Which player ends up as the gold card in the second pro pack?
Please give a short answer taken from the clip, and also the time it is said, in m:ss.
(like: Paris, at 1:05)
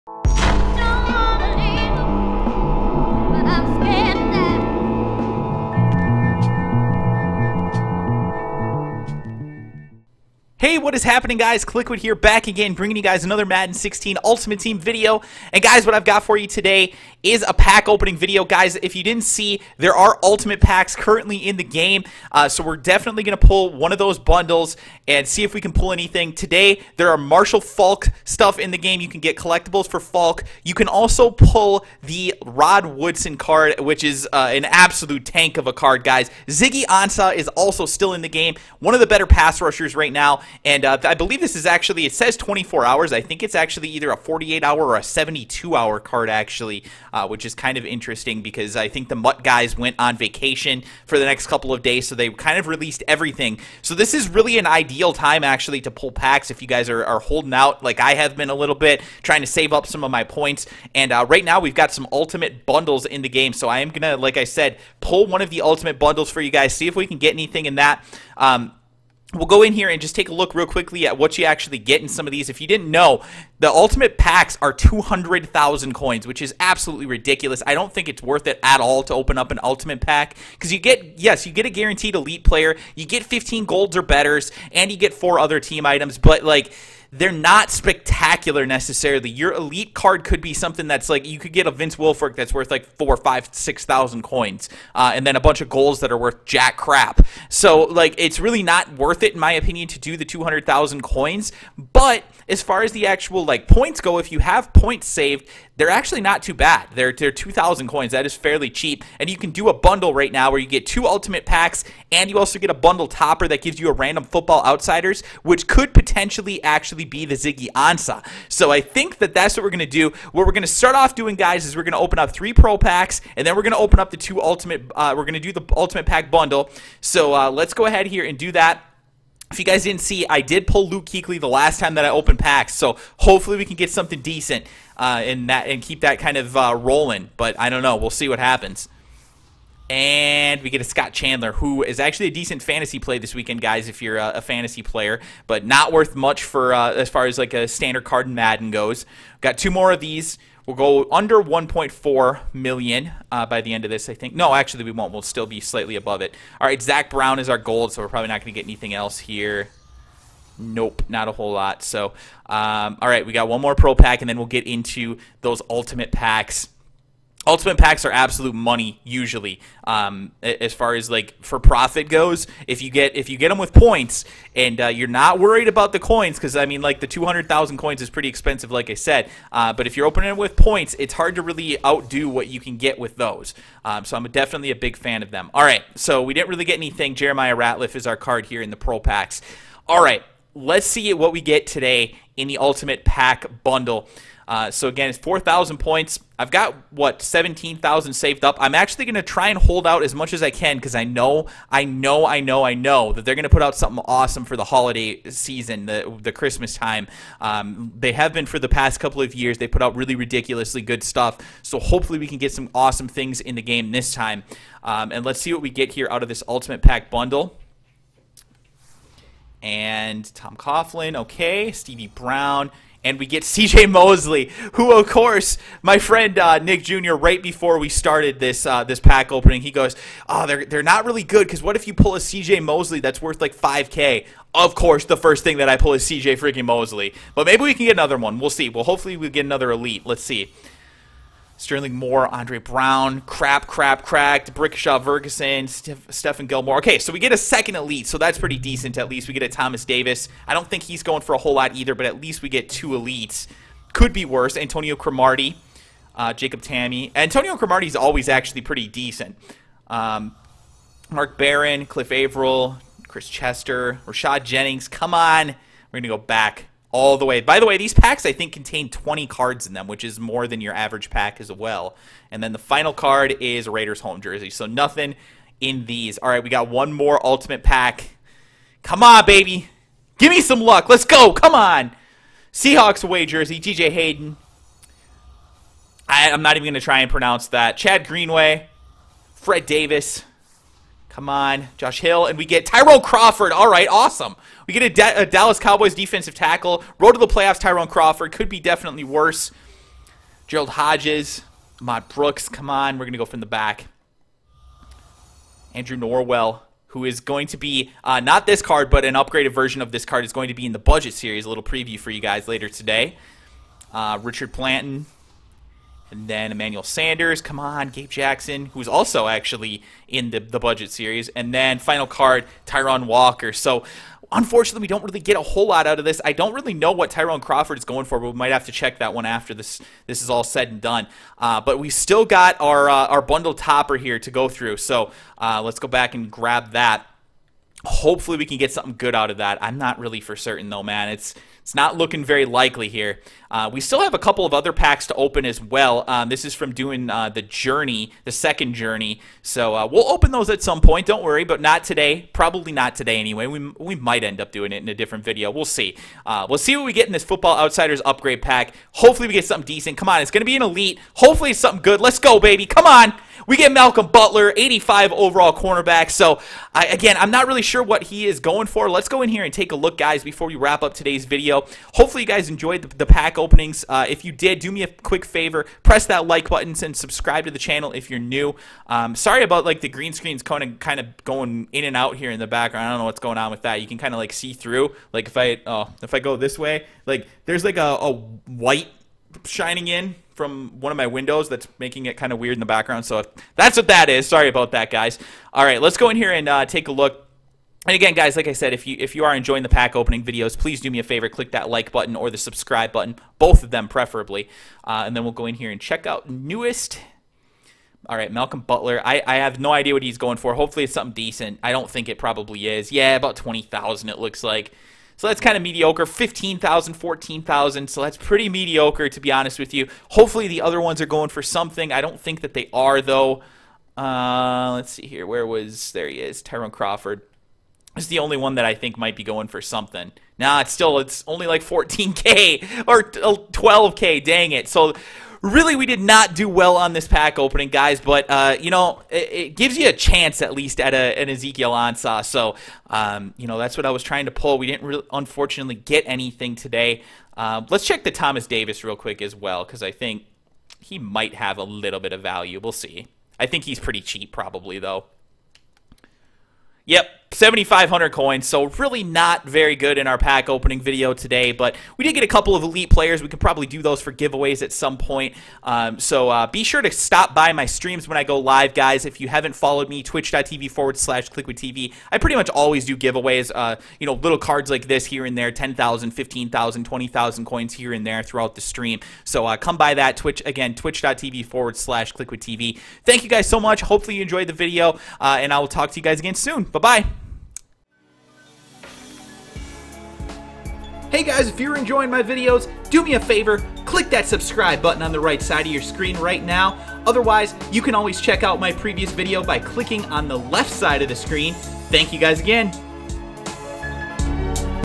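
Zach Brown, at 2:36.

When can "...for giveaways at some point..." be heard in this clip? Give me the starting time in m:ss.
7:44.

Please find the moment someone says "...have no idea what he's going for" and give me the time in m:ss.
6:49.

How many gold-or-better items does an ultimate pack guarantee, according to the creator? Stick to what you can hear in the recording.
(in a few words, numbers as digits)
15.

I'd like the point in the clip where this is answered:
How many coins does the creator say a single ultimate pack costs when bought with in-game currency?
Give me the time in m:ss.
1:14.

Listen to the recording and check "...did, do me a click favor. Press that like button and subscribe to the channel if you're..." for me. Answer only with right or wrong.
wrong.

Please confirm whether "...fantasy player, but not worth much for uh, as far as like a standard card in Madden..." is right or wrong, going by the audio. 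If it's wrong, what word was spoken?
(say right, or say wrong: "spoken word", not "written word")
right.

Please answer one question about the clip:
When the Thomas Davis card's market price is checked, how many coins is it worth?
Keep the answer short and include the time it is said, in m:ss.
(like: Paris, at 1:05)
7,500, at 7:37.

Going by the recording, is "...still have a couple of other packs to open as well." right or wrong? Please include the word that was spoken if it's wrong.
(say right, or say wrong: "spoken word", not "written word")
right.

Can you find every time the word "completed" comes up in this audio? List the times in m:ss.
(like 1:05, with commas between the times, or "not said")
not said.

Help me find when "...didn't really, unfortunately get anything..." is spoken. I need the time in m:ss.
7:24.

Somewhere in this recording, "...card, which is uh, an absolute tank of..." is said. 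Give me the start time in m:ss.
0:33.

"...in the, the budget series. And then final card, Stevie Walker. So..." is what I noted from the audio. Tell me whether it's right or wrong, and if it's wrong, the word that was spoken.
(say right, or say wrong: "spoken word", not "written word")
wrong: "Tyron", not "Stevie".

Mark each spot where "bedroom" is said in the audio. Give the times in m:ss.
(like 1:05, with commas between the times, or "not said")
not said.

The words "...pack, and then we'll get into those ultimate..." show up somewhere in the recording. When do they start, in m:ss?
2:43.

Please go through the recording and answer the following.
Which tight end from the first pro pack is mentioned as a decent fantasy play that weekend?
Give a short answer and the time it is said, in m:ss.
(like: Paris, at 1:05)
Scott Chandler, at 2:20.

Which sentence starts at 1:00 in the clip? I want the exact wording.
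And uh, right now, we've got some ultimate bundles in the game.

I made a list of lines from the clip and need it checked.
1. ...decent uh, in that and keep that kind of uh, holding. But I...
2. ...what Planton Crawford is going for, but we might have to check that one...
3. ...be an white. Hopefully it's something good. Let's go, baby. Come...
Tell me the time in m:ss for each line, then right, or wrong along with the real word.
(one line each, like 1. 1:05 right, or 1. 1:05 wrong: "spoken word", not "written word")
1. 2:14 wrong: "rolling", not "holding"
2. 5:26 wrong: "Tyrone", not "Planton"
3. 6:00 wrong: "elite", not "white".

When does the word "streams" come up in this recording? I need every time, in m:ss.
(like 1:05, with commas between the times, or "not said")
7:47, 7:58.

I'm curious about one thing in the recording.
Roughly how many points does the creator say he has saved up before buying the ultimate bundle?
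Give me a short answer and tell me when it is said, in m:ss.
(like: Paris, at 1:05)
17,000, at 3:17.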